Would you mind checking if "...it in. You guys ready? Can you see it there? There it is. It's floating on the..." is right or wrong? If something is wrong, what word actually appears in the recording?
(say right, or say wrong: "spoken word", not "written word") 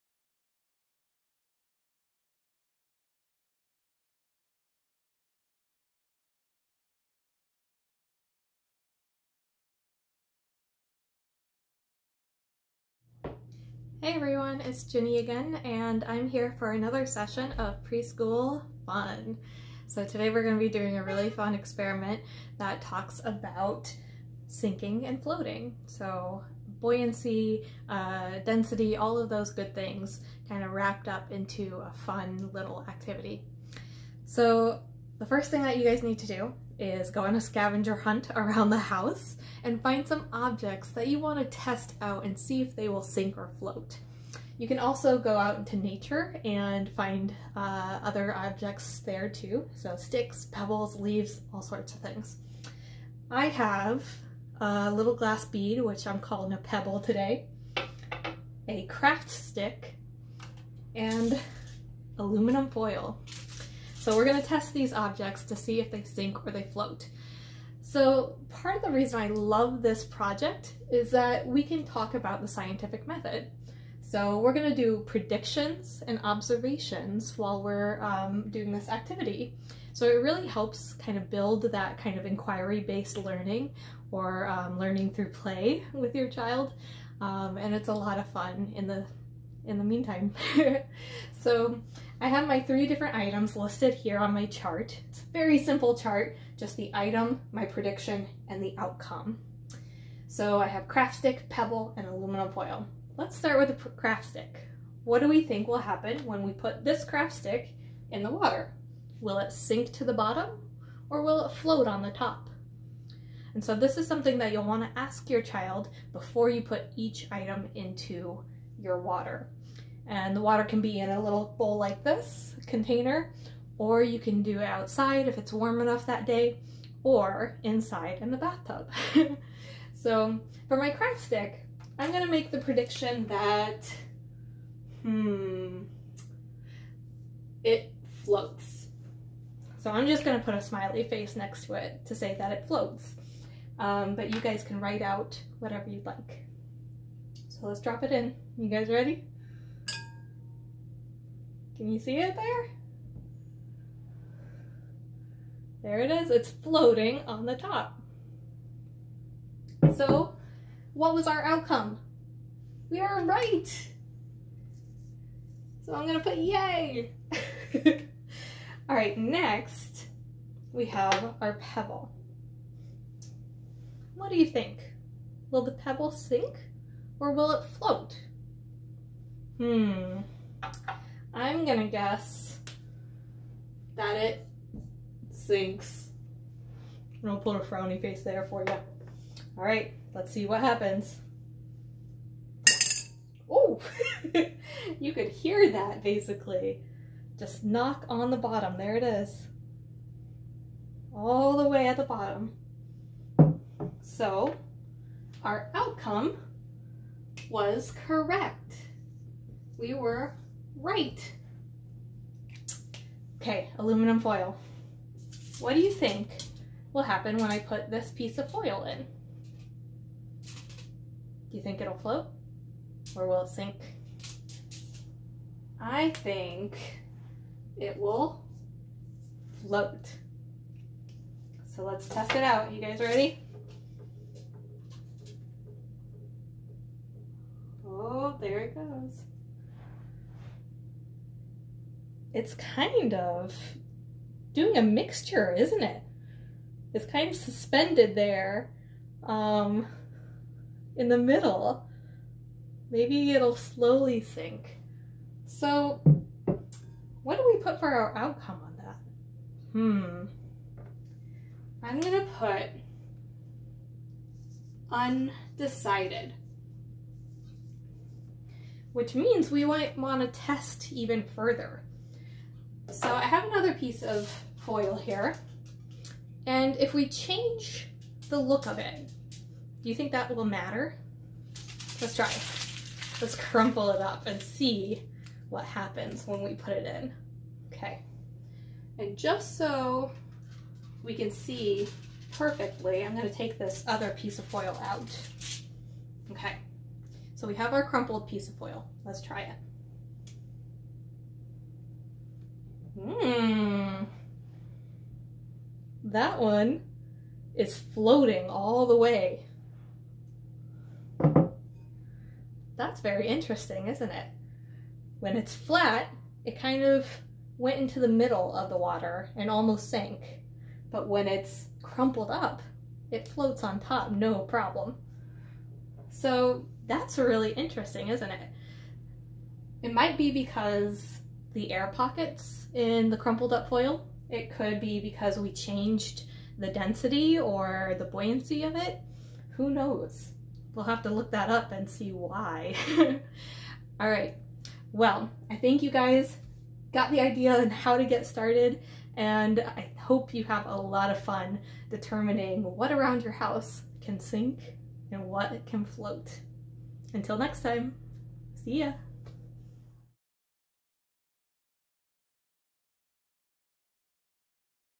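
right.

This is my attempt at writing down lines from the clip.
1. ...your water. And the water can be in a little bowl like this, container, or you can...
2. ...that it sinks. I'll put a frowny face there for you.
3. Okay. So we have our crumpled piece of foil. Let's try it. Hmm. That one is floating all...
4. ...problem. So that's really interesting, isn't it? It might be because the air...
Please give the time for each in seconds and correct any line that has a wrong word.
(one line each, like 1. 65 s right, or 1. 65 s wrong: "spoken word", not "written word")
1. 118 s right
2. 183 s right
3. 296 s right
4. 324 s right.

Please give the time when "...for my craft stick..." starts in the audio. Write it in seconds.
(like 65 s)
130 s.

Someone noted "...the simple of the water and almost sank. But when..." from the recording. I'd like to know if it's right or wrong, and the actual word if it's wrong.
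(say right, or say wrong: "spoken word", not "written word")
wrong: "middle", not "simple".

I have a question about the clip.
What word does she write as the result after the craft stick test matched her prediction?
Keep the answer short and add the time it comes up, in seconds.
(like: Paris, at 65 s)
yay, at 166 s.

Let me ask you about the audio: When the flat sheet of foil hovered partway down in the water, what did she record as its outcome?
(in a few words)
undecided.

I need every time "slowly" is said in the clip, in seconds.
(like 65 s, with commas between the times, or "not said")
253 s.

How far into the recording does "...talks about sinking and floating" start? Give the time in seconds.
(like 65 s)
22 s.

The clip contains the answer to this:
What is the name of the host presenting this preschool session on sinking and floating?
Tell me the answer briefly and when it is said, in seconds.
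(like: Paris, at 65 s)
Ginny, at 14 s.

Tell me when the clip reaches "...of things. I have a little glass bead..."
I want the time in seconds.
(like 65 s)
51 s.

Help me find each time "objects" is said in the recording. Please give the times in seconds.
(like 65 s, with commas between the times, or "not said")
40 s, 48 s, 64 s.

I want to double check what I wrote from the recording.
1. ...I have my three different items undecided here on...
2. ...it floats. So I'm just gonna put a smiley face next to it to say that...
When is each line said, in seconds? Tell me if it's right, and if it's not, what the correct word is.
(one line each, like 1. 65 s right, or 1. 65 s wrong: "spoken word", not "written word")
1. 92 s wrong: "listed", not "undecided"
2. 137 s right.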